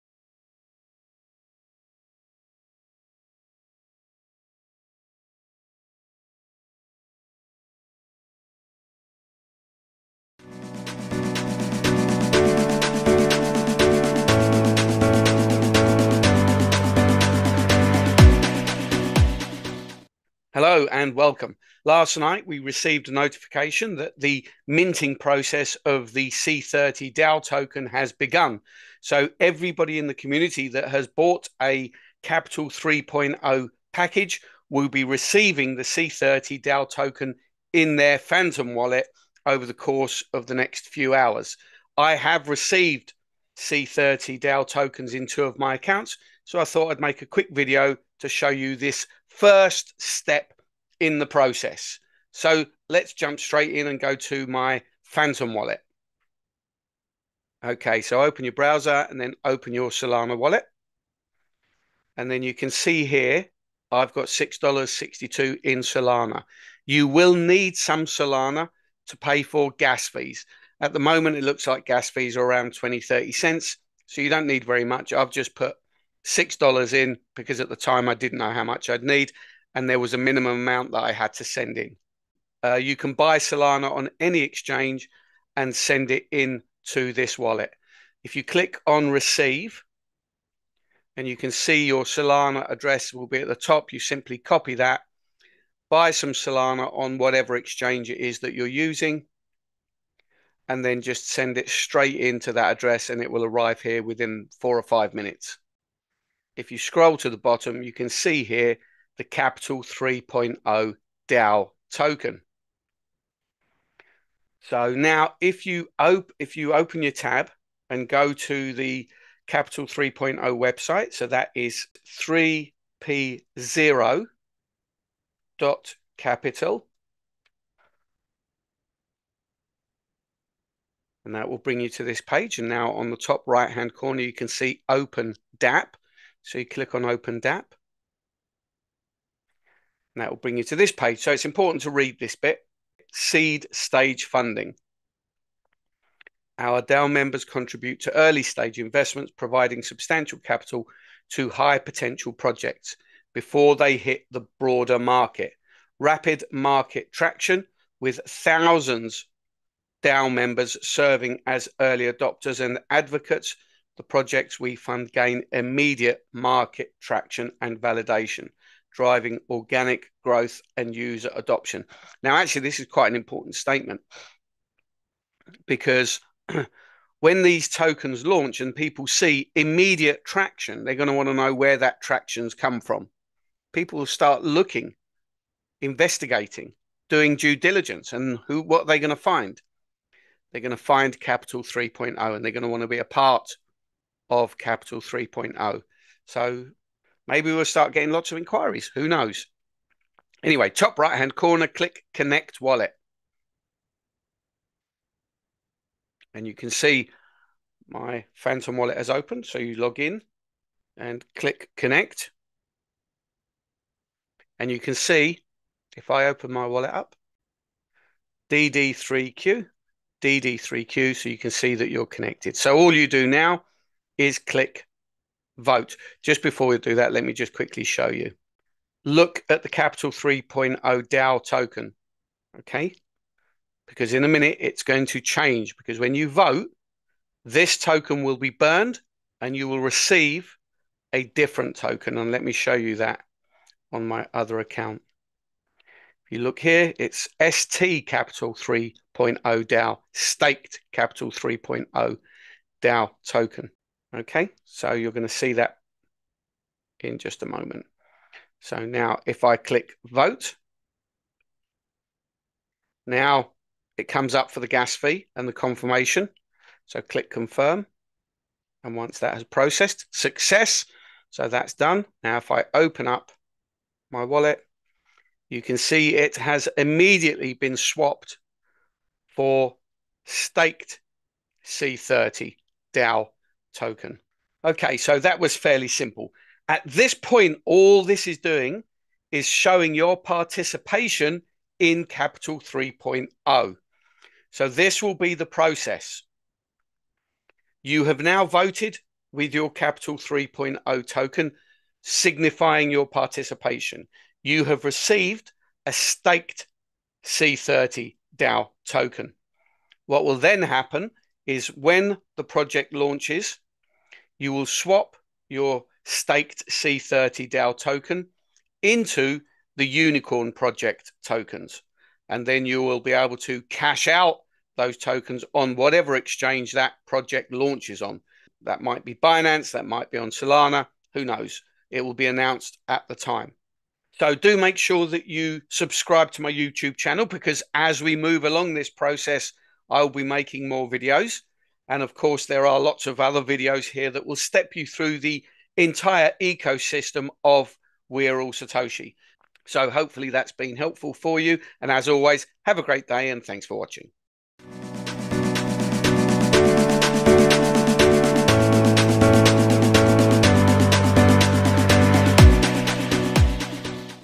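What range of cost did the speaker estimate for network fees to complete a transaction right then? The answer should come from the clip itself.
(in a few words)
20, 30 cents.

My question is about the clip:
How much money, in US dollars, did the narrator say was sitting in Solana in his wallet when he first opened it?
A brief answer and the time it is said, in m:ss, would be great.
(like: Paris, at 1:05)
$6.62, at 1:04.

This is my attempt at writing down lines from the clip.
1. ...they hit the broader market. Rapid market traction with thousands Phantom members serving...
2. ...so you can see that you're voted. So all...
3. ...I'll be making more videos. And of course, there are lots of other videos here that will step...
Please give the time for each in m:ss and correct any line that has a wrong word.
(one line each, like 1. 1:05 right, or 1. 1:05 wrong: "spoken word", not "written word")
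1. 2:33 wrong: "DAO", not "Phantom"
2. 3:41 wrong: "connected", not "voted"
3. 5:39 right.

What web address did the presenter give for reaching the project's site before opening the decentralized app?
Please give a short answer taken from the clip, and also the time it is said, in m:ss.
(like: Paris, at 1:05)
3p0.capital, at 2:02.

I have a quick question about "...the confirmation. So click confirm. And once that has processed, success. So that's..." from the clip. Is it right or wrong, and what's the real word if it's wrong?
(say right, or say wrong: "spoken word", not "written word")
right.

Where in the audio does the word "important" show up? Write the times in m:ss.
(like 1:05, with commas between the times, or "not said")
2:21, 2:53.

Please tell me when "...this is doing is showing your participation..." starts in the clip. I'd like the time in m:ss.
4:48.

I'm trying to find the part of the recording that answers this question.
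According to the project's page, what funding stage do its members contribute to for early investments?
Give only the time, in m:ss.
2:23.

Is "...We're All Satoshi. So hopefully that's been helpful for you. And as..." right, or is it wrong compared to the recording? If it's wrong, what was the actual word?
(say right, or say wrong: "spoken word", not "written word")
right.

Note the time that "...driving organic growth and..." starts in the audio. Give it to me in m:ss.
2:48.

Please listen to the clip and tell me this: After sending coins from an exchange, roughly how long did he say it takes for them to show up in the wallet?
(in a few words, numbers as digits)
4 or 5 minutes.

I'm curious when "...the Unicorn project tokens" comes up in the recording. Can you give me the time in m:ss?
5:19.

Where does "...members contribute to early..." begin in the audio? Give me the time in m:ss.
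2:27.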